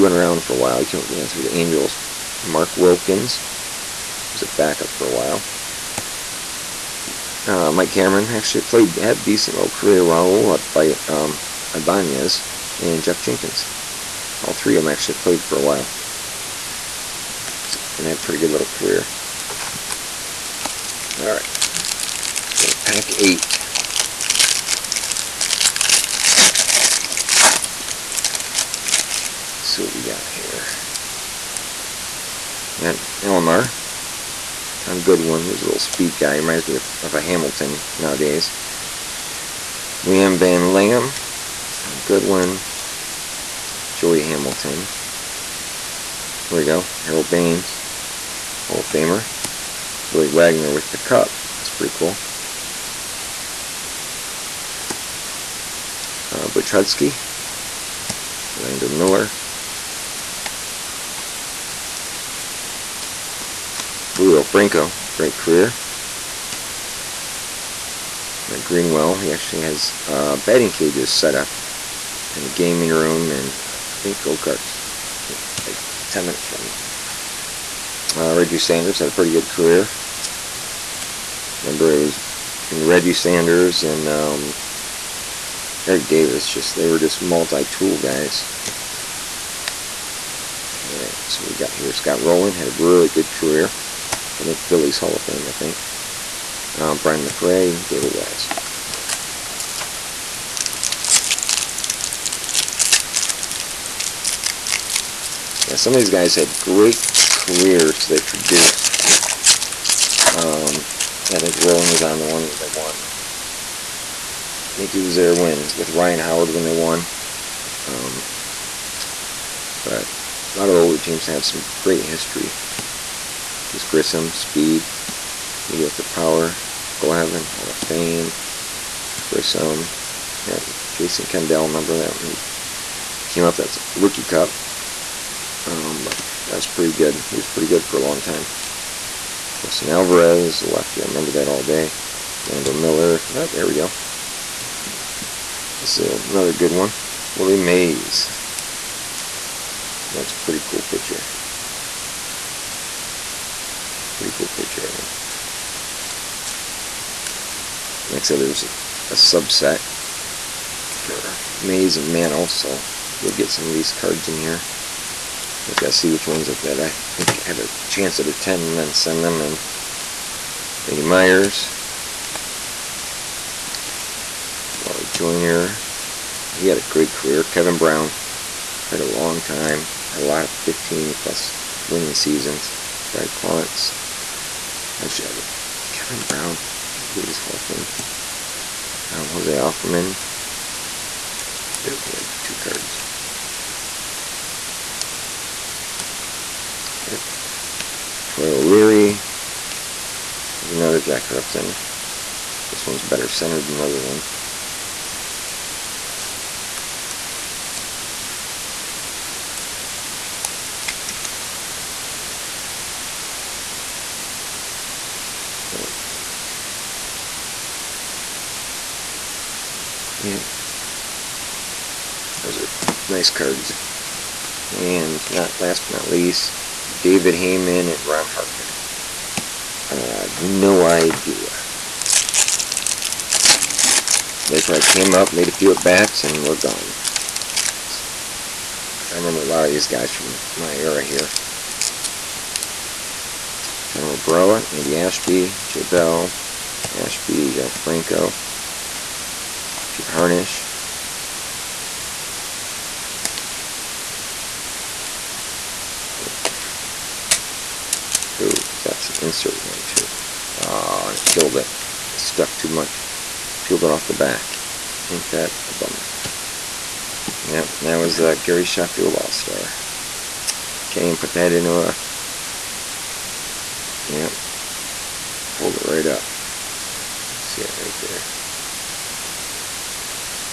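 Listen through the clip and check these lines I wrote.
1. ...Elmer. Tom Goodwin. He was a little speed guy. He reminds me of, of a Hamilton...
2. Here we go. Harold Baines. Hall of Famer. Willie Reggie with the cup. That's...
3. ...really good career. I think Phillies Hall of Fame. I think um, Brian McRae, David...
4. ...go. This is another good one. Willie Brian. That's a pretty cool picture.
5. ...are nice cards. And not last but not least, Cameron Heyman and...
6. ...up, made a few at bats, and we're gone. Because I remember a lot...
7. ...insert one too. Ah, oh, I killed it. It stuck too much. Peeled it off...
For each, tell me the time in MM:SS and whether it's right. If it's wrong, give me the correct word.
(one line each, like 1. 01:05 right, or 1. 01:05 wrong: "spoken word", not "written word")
1. 00:33 right
2. 00:46 wrong: "Wagner", not "Reggie"
3. 01:32 right
4. 02:23 wrong: "Mays", not "Brian"
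5. 03:42 wrong: "David", not "Cameron"
6. 03:55 right
7. 04:19 right.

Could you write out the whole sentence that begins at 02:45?
I just gotta see which ones that, that I think have a chance at a 10 and then send them in.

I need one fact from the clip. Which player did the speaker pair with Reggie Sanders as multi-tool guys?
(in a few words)
Eric Davis.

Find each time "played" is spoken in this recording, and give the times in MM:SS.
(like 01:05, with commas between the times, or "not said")
00:08, 00:15.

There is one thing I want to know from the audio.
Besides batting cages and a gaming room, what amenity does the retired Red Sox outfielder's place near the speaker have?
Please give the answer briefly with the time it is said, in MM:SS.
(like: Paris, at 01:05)
go-kart, at 01:14.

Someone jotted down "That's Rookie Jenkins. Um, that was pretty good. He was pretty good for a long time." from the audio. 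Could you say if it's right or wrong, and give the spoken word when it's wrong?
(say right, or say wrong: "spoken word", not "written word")
wrong: "Cup", not "Jenkins".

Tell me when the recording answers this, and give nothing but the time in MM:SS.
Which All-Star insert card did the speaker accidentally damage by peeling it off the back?
04:28.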